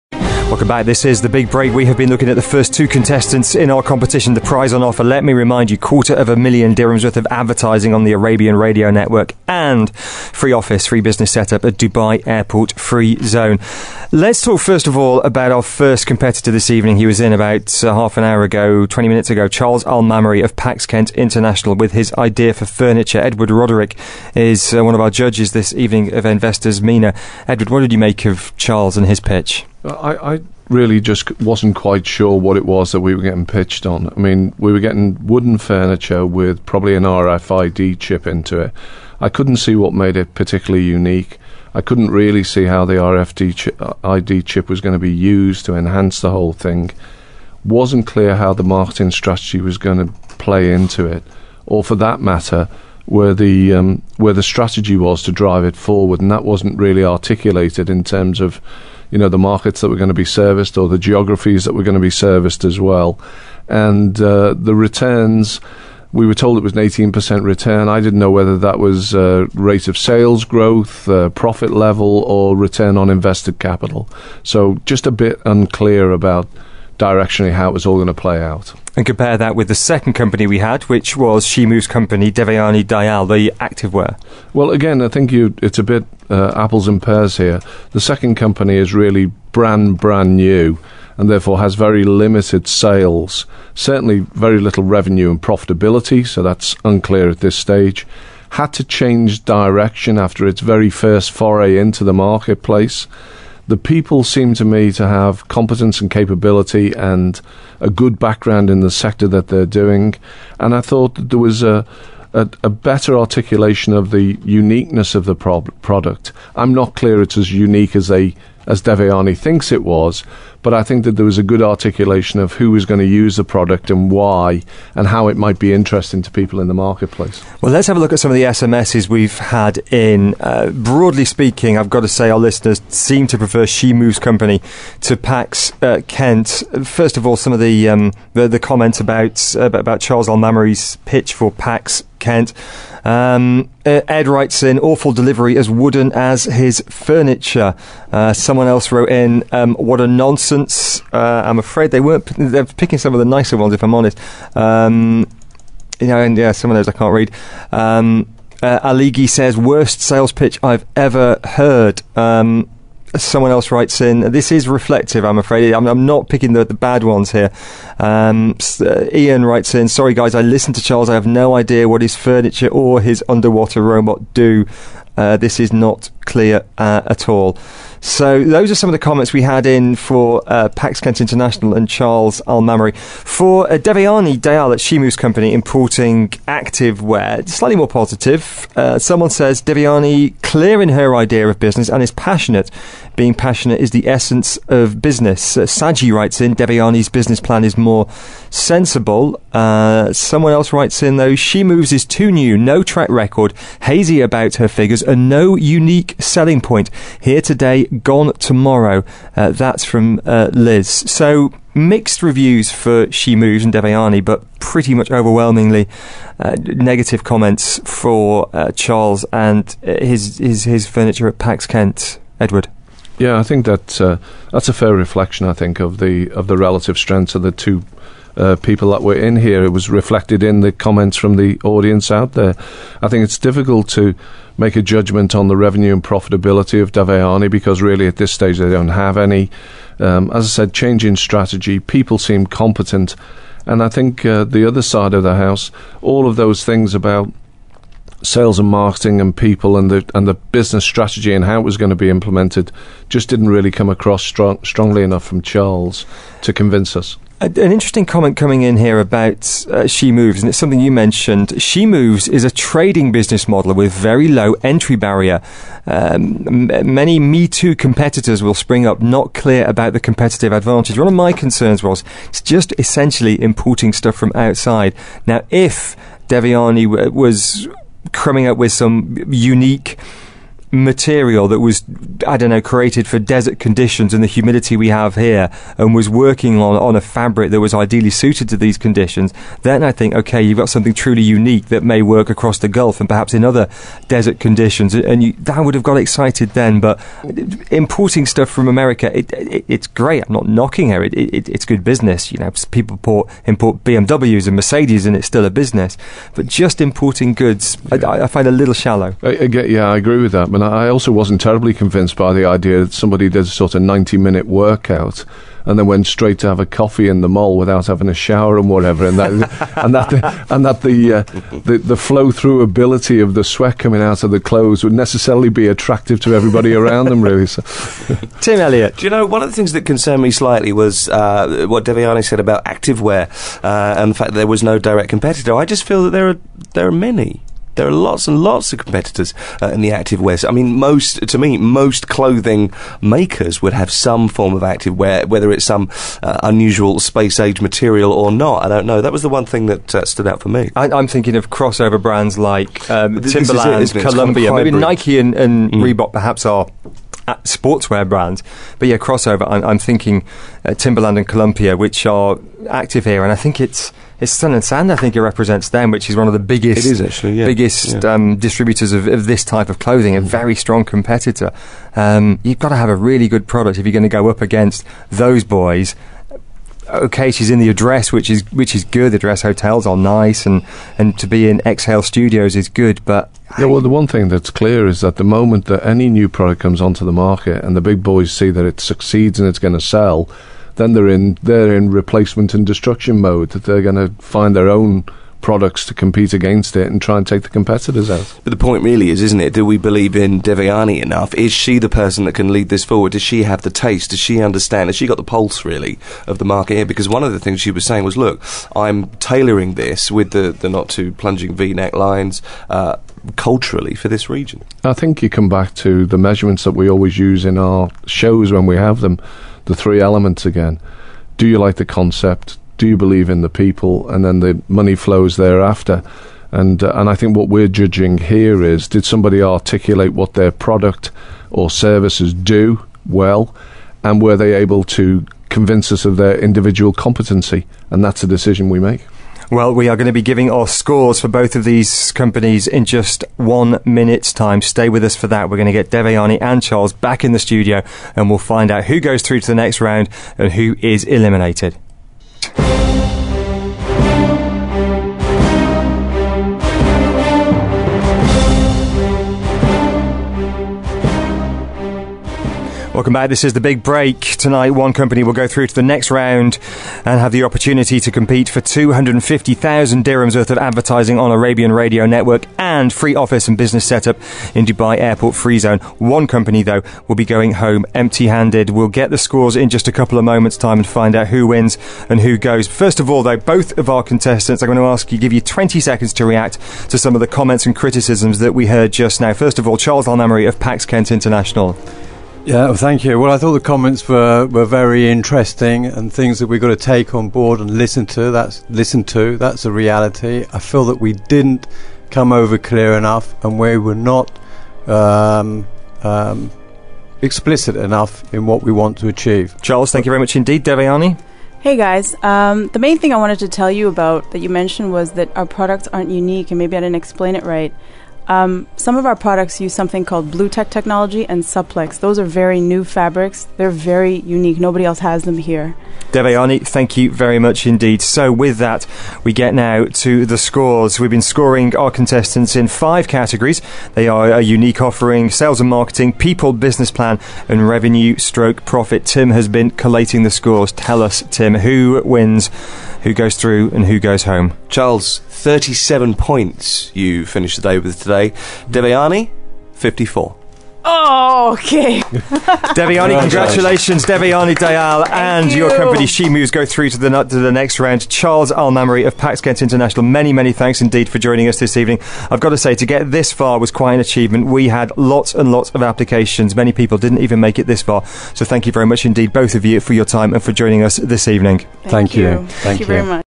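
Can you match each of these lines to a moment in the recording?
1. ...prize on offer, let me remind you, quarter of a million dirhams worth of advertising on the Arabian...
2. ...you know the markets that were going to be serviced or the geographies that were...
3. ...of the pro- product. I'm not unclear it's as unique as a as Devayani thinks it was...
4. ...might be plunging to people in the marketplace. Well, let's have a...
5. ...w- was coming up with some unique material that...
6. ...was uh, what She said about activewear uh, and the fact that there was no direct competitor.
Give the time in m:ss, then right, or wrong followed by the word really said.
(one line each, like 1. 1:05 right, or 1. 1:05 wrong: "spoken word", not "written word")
1. 0:04 right
2. 0:59 right
3. 1:55 wrong: "clear", not "unclear"
4. 2:05 wrong: "interesting", not "plunging"
5. 4:36 right
6. 5:30 wrong: "Devayani", not "She".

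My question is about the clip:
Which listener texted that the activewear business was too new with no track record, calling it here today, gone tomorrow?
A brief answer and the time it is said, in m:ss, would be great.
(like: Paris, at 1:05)
Liz, at 3:30.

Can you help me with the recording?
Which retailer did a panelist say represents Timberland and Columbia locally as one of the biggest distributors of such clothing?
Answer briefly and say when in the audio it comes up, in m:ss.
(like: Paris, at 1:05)
Sun and Sand, at 6:04.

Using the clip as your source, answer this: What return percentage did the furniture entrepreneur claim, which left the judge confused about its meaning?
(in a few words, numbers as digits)
18%.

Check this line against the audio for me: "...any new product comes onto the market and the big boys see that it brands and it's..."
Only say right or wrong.
wrong.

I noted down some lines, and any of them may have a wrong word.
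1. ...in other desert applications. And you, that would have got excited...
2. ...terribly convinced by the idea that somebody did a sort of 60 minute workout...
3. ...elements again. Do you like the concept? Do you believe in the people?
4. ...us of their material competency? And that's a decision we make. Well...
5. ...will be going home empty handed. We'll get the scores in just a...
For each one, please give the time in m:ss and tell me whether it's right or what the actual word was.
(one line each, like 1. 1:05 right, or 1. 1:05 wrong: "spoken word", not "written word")
1. 4:53 wrong: "conditions", not "applications"
2. 5:11 wrong: "90", not "60"
3. 6:59 right
4. 7:15 wrong: "individual", not "material"
5. 7:57 right.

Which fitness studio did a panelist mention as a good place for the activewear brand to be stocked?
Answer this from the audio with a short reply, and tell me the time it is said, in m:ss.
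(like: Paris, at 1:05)
Exhale Studios, at 6:21.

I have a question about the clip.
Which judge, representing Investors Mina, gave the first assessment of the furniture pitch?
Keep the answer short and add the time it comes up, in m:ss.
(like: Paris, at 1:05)
Edward Roderick, at 0:23.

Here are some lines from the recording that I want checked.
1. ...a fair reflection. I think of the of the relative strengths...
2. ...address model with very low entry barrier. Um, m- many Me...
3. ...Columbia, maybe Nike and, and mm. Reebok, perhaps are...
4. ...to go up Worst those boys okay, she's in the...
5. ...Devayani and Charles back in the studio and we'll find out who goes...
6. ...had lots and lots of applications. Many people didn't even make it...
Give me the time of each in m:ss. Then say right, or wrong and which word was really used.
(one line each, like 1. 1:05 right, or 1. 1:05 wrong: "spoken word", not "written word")
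1. 3:44 right
2. 4:23 wrong: "business", not "address"
3. 5:54 right
4. 6:14 wrong: "against", not "Worst"
5. 7:25 right
6. 9:24 right.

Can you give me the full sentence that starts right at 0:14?
Let's talk first of all about our first competitor this evening.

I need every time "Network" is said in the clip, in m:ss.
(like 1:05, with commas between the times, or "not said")
0:08, 7:52.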